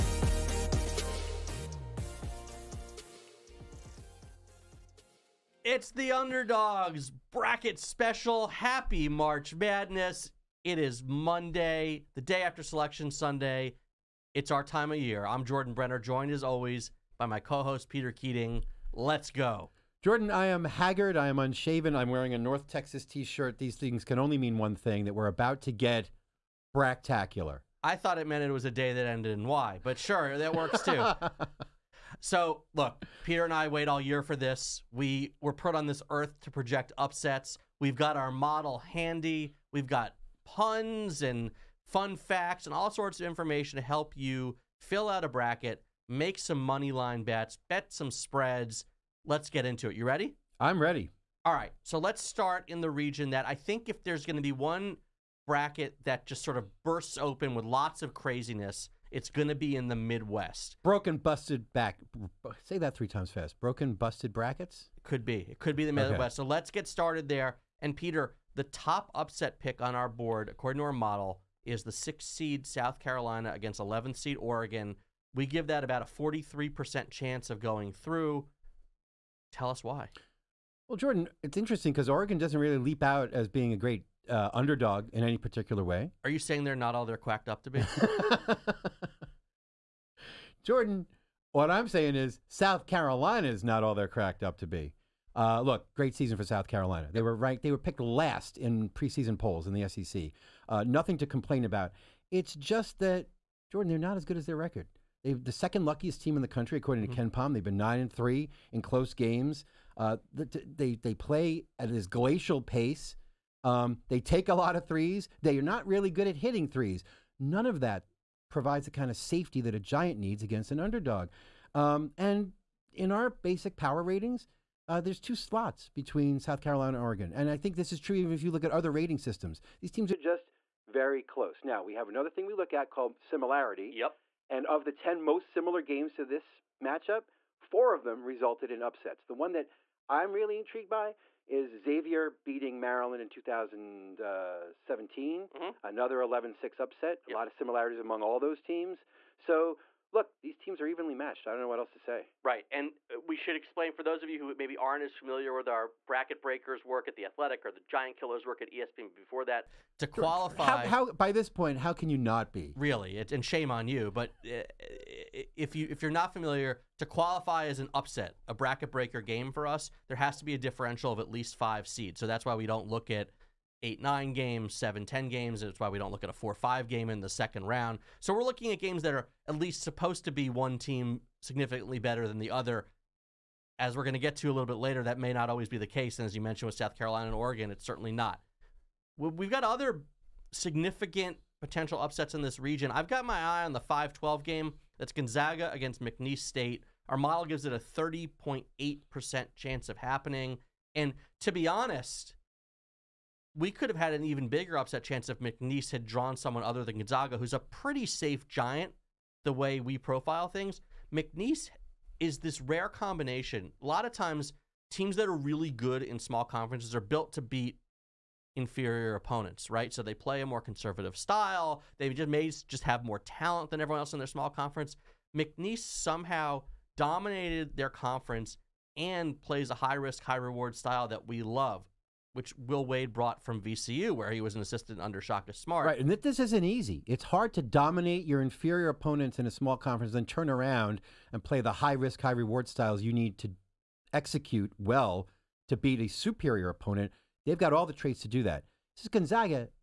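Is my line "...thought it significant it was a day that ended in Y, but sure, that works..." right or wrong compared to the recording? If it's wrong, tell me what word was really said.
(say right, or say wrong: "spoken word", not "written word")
wrong: "meant", not "significant".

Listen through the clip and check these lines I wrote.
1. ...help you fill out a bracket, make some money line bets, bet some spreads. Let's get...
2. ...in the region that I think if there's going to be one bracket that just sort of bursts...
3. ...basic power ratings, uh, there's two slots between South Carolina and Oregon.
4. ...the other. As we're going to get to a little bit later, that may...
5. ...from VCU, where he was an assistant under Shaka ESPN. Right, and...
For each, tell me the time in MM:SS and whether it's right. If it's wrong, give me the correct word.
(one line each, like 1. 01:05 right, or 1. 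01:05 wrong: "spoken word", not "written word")
1. 00:43 right
2. 00:52 right
3. 02:03 right
4. 03:02 right
5. 03:53 wrong: "Smart", not "ESPN".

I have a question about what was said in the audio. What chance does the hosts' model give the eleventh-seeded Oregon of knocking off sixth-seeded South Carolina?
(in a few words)
43%.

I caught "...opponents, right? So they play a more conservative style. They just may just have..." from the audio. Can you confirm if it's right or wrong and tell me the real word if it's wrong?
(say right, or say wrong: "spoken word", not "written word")
right.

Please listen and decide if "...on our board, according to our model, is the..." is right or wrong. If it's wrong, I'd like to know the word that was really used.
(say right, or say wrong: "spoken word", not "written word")
right.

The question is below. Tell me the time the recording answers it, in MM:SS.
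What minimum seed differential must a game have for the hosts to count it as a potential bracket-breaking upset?
02:51.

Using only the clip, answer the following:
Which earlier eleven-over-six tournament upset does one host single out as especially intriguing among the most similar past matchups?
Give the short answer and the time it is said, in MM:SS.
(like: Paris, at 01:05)
Xavier beating Maryland in 2017, at 02:21.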